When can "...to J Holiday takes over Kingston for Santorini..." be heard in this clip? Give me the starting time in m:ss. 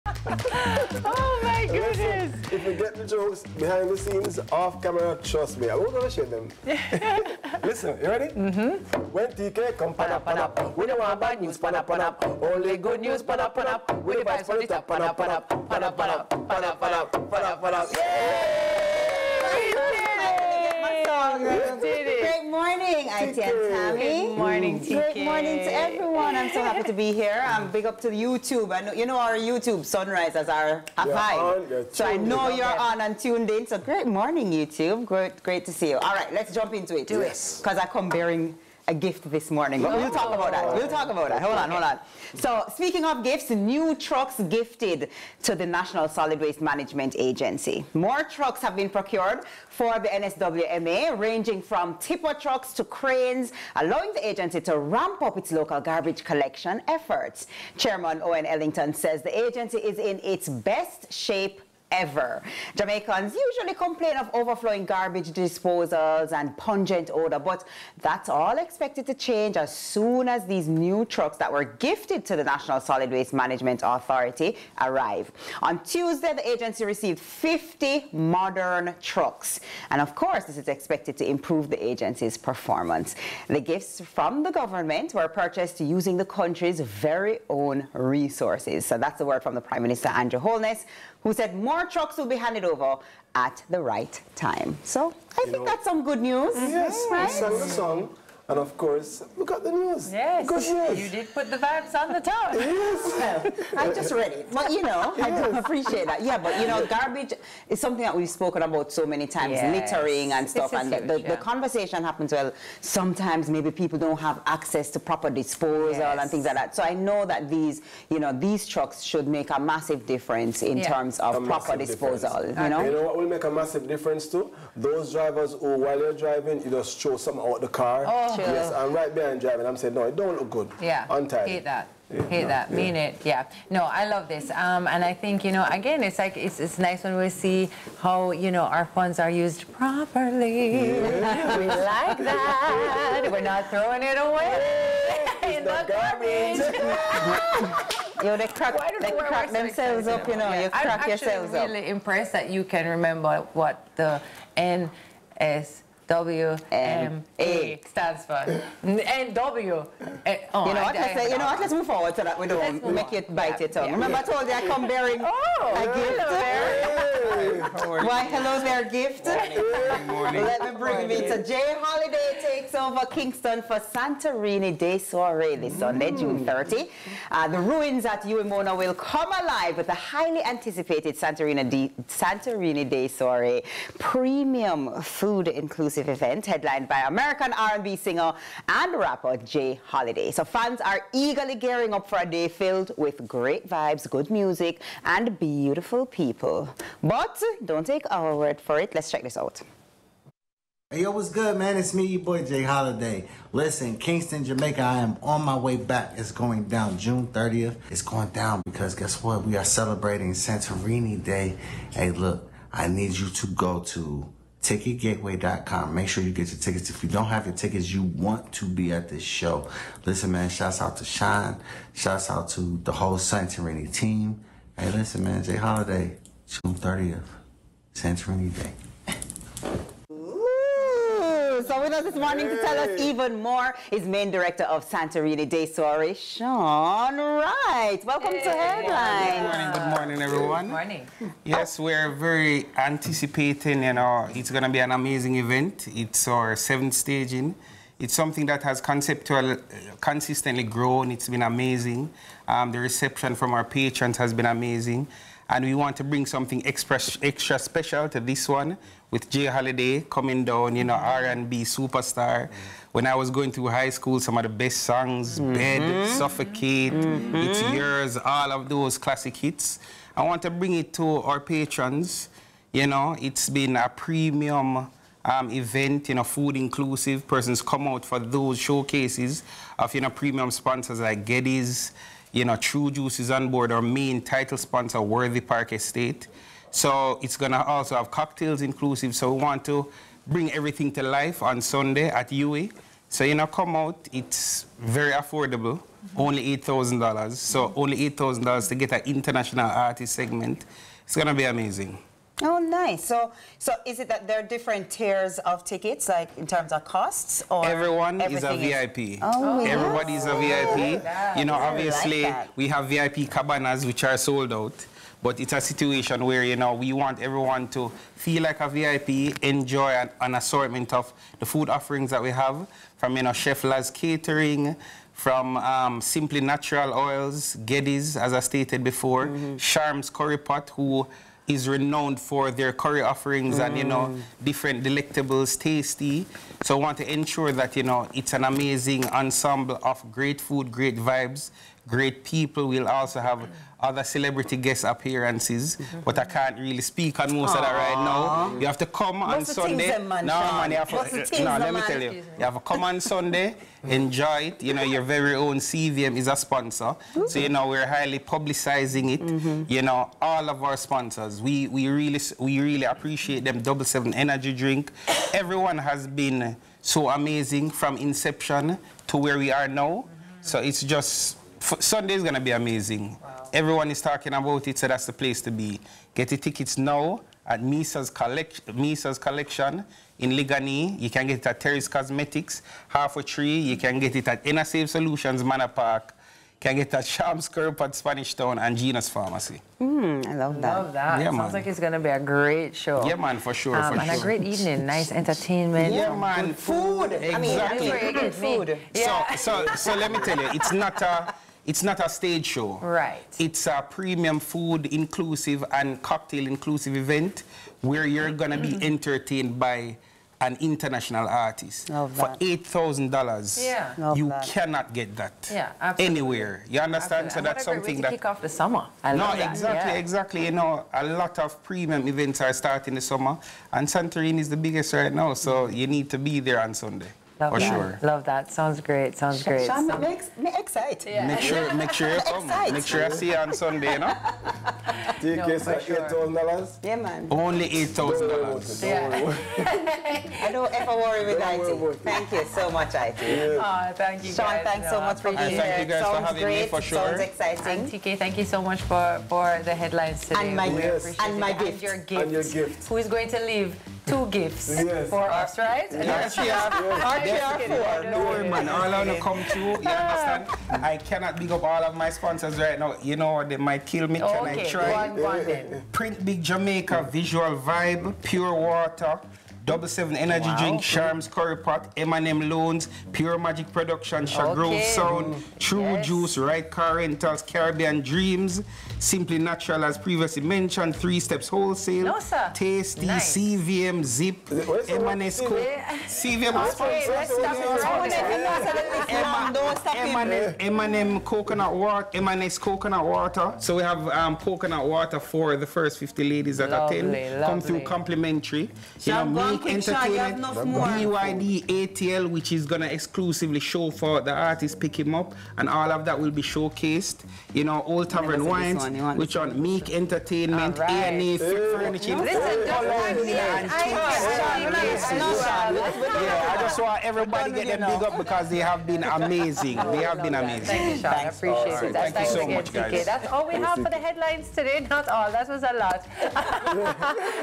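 2:51.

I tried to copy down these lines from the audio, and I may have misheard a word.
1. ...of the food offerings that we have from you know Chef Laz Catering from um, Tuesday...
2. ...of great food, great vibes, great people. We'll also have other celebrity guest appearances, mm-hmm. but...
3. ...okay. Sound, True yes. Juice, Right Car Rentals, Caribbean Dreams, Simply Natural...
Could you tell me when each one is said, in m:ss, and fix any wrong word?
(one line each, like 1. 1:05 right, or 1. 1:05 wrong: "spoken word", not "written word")
1. 5:20 wrong: "Simply", not "Tuesday"
2. 5:39 right
3. 7:54 right.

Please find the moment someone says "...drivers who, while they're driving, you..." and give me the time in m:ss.
2:05.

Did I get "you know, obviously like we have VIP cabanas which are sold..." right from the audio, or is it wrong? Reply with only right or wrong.
right.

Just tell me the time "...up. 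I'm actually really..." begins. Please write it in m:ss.
2:31.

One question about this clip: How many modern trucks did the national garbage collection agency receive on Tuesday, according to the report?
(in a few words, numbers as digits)
50.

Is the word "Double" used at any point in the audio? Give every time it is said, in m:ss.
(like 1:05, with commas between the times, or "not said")
6:03, 7:49.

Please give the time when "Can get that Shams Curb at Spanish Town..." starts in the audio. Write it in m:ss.
6:26.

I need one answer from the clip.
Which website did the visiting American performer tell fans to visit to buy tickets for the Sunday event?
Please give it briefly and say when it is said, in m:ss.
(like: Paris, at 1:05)
ticketgateway.com, at 3:34.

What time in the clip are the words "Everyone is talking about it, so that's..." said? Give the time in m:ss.
6:13.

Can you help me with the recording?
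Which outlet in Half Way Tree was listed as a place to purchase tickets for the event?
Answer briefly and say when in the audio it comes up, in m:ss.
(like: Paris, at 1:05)
Terry's Cosmetics, at 6:21.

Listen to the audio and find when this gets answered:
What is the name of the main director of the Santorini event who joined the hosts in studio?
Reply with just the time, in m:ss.
3:56.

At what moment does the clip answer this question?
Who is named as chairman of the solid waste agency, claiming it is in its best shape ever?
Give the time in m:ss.
0:58.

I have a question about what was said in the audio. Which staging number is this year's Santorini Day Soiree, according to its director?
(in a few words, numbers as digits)
seventh.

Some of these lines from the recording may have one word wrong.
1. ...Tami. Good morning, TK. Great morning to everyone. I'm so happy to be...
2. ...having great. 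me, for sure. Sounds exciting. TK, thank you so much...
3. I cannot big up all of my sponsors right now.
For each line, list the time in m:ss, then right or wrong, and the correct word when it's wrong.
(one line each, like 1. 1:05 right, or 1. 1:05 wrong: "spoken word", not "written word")
1. 0:23 right
2. 7:26 right
3. 7:40 right.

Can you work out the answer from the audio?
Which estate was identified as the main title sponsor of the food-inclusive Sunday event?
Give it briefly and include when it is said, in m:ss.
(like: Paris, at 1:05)
Worthy Park Estate, at 4:45.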